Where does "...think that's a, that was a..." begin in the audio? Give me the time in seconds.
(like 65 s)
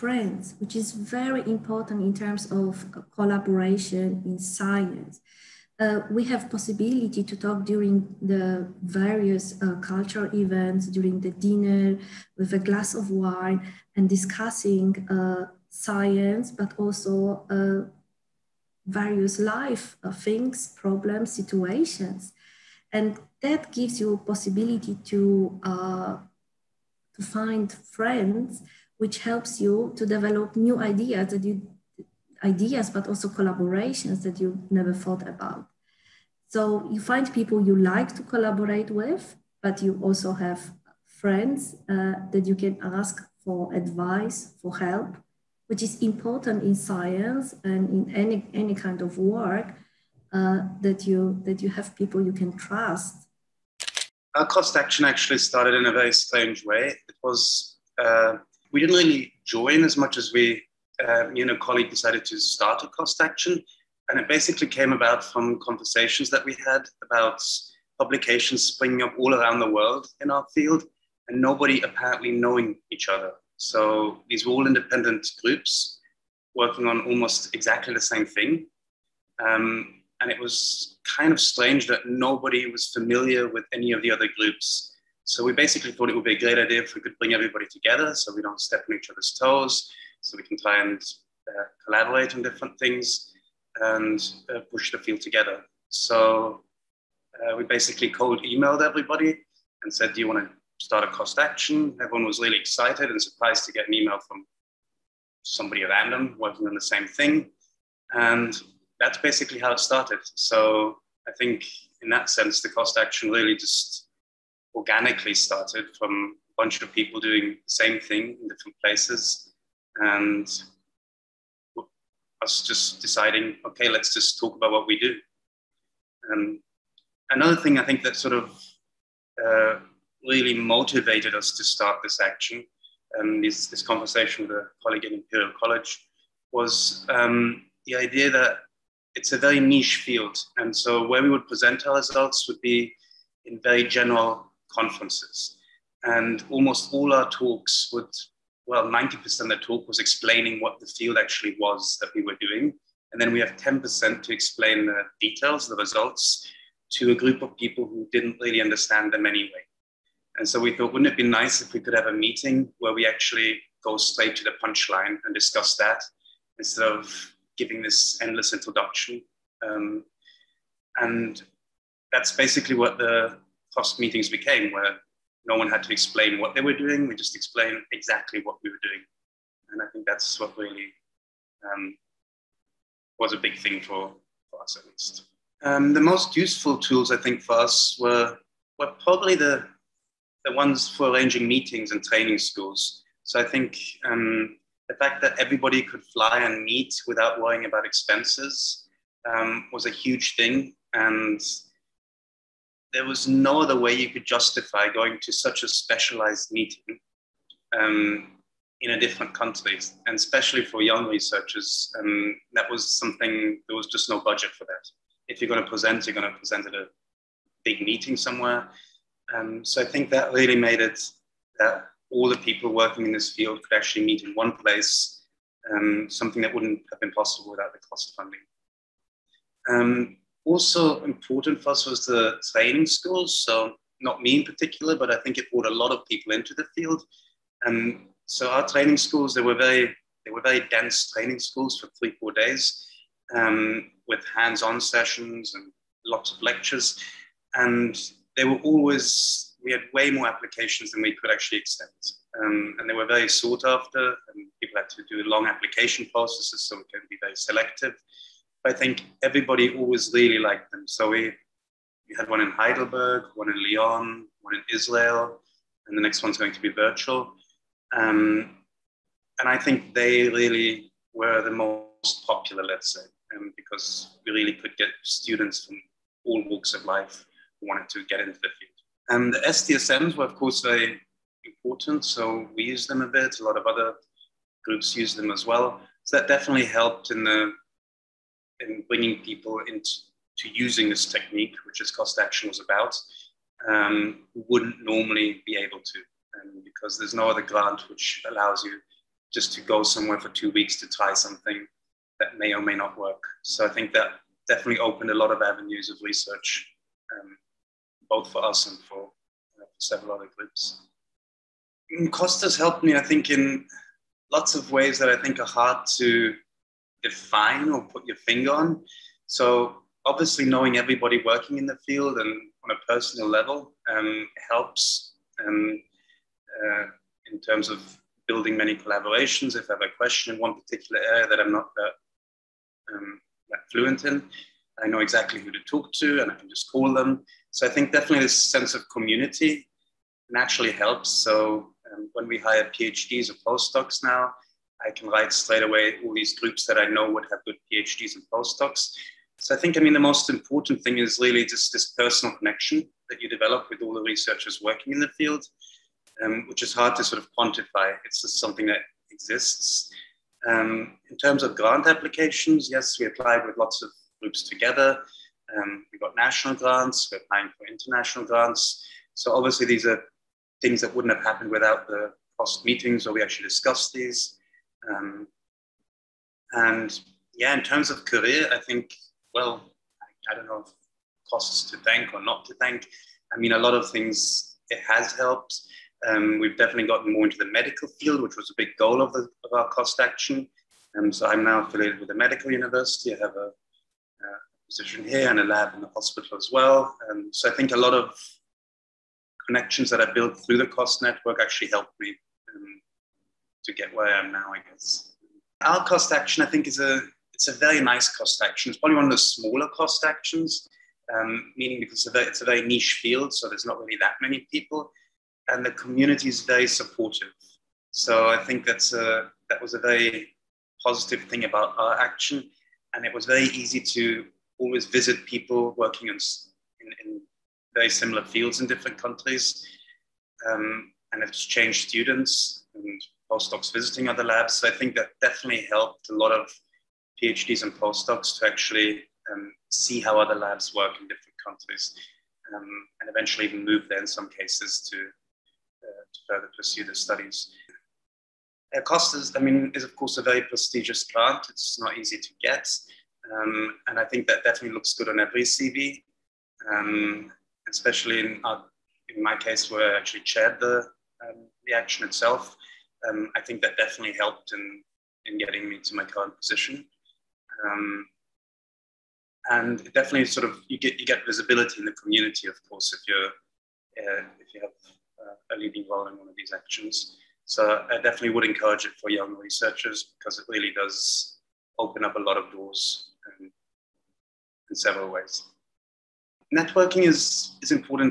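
418 s.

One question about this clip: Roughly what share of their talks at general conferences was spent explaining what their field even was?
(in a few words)
90%.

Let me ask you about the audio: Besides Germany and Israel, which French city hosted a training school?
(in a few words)
Lyon.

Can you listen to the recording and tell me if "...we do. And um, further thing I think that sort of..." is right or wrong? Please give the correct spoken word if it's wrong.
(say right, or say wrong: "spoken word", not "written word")
wrong: "another", not "further".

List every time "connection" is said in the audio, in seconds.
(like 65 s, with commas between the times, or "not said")
352 s, 399 s.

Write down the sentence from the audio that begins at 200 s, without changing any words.
And there was no other way you could justify going to such a specialized meeting um, in a different country.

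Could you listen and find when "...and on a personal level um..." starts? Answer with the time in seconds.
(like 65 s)
322 s.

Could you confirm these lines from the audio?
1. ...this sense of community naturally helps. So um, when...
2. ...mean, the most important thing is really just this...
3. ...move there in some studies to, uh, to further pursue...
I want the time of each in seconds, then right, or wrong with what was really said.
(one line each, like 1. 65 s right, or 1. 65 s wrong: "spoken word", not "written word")
1. 338 s right
2. 349 s right
3. 443 s wrong: "cases", not "studies".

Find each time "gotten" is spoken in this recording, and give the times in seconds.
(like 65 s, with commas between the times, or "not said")
386 s.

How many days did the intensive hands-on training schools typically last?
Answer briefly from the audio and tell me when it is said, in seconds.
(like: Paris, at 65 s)
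3-4 days, at 241 s.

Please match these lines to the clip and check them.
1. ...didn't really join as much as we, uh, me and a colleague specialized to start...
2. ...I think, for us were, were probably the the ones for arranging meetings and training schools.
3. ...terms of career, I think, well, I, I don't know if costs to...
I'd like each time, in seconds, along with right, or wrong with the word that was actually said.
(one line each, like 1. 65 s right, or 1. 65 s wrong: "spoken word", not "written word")
1. 58 s wrong: "decided", not "specialized"
2. 187 s right
3. 377 s right.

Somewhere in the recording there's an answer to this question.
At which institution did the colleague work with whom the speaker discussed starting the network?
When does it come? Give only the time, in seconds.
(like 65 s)
135 s.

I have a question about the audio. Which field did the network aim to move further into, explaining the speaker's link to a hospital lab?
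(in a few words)
Medical field.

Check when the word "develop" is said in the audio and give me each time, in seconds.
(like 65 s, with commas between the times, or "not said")
30 s, 353 s.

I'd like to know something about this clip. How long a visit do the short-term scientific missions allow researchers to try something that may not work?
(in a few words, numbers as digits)
Two weeks.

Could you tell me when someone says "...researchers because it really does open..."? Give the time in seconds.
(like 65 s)
479 s.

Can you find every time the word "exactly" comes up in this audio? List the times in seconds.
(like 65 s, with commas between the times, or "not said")
77 s, 177 s, 334 s.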